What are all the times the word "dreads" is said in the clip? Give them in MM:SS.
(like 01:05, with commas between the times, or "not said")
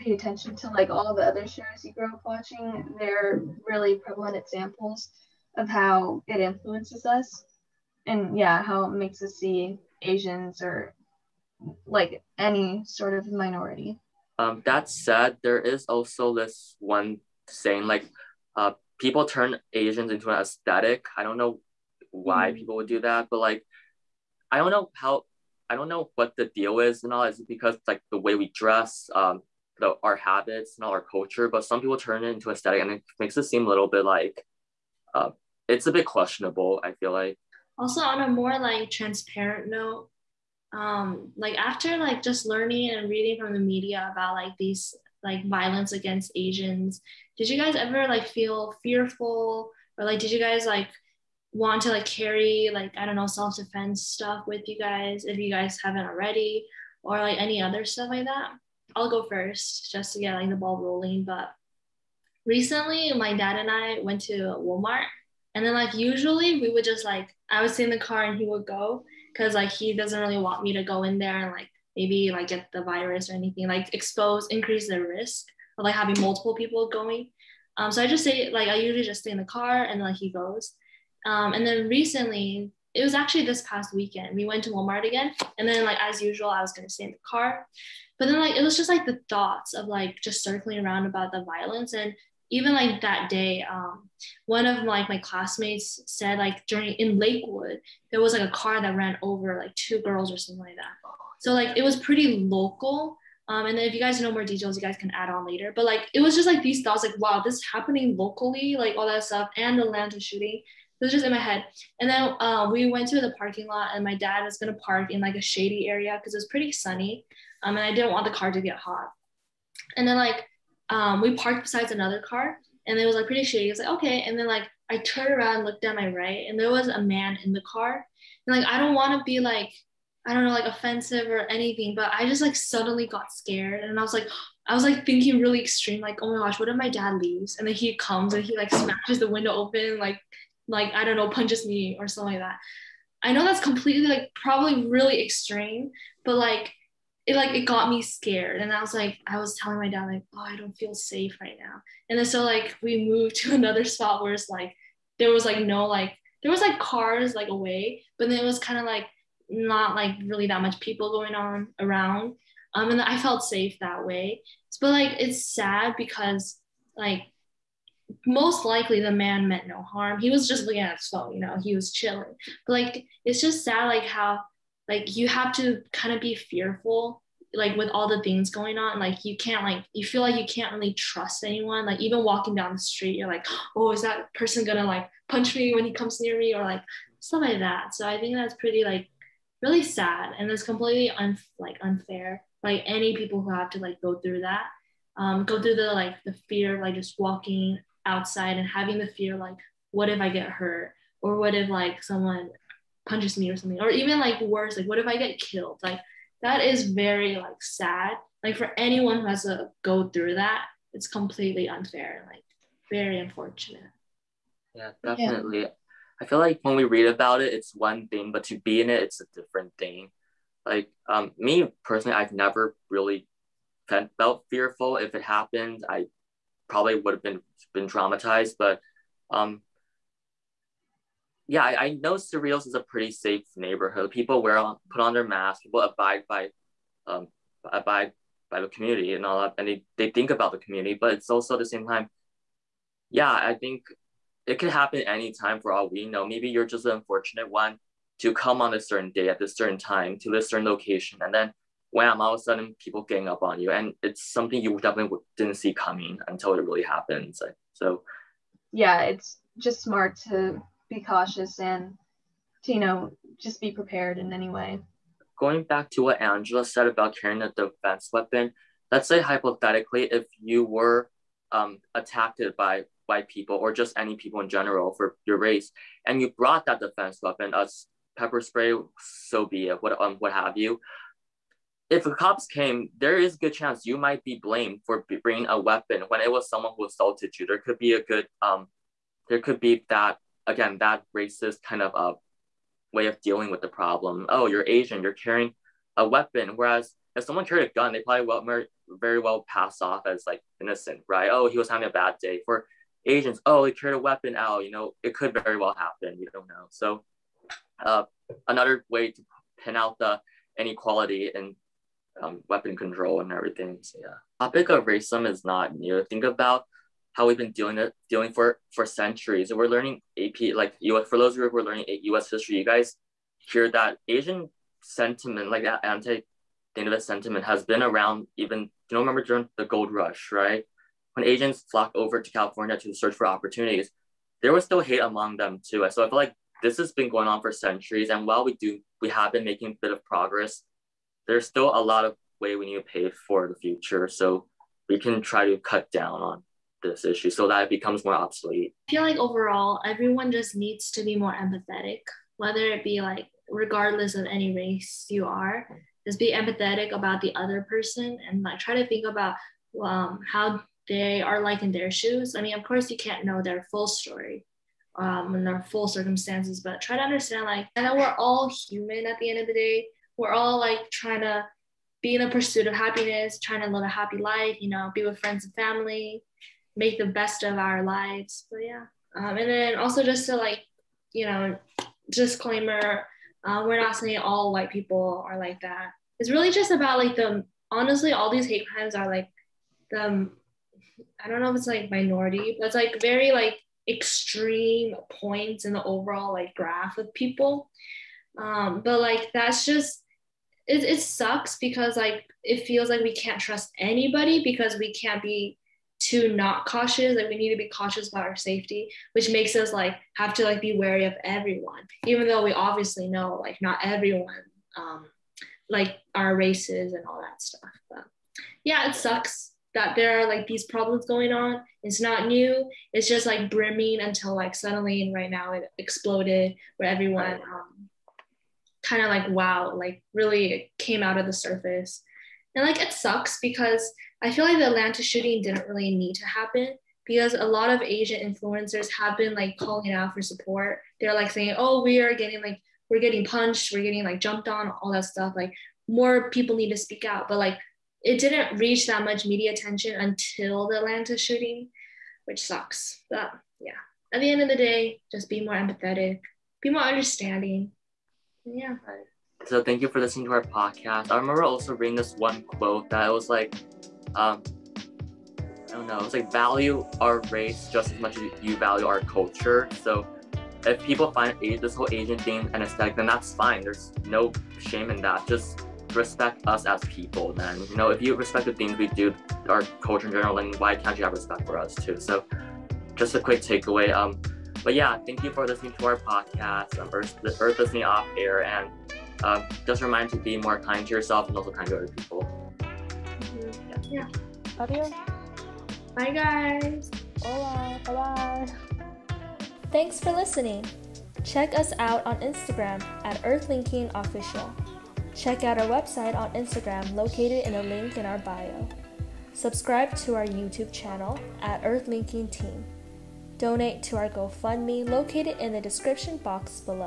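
not said.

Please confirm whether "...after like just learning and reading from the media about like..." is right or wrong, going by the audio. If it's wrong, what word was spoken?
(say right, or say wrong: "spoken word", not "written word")
right.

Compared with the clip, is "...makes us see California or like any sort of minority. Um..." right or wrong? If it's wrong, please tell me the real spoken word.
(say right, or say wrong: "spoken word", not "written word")
wrong: "Asians", not "California".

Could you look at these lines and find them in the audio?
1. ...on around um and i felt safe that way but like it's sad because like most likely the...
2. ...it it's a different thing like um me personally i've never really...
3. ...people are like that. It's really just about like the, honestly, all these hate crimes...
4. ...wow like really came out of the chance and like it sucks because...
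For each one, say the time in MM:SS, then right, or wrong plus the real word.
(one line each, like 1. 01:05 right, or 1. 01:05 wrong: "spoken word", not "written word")
1. 02:41 right
2. 03:38 right
3. 06:24 right
4. 07:09 wrong: "surface", not "chance".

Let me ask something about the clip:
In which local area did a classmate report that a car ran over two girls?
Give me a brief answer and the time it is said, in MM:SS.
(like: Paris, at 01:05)
Lakewood, at 01:37.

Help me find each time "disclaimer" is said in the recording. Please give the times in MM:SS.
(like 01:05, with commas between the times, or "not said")
06:22.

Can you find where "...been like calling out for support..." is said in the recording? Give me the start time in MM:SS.
07:19.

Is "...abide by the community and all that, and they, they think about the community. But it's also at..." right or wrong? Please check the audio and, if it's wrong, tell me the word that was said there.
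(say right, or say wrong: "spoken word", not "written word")
right.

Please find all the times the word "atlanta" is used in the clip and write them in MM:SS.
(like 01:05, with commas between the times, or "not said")
01:49, 07:14, 07:30.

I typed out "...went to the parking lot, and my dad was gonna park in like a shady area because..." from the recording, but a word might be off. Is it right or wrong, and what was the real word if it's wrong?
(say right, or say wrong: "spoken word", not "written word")
right.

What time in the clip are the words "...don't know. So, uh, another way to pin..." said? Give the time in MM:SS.
05:06.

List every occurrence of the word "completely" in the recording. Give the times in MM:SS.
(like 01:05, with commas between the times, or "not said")
02:23, 03:10, 03:31.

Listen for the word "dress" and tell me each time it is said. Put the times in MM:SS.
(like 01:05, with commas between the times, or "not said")
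00:28.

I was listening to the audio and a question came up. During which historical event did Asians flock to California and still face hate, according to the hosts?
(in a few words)
The gold rush.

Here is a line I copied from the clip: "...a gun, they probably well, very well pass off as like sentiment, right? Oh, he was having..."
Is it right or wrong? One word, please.
wrong.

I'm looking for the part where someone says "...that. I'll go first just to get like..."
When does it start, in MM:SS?
00:58.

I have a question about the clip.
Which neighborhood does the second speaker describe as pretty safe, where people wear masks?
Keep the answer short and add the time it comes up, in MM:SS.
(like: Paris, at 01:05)
Cerritos, at 03:52.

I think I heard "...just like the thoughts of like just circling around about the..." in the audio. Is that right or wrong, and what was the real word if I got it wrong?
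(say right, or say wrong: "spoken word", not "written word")
right.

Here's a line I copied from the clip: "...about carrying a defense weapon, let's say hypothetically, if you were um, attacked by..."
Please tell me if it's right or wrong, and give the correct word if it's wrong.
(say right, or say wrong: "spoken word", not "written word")
right.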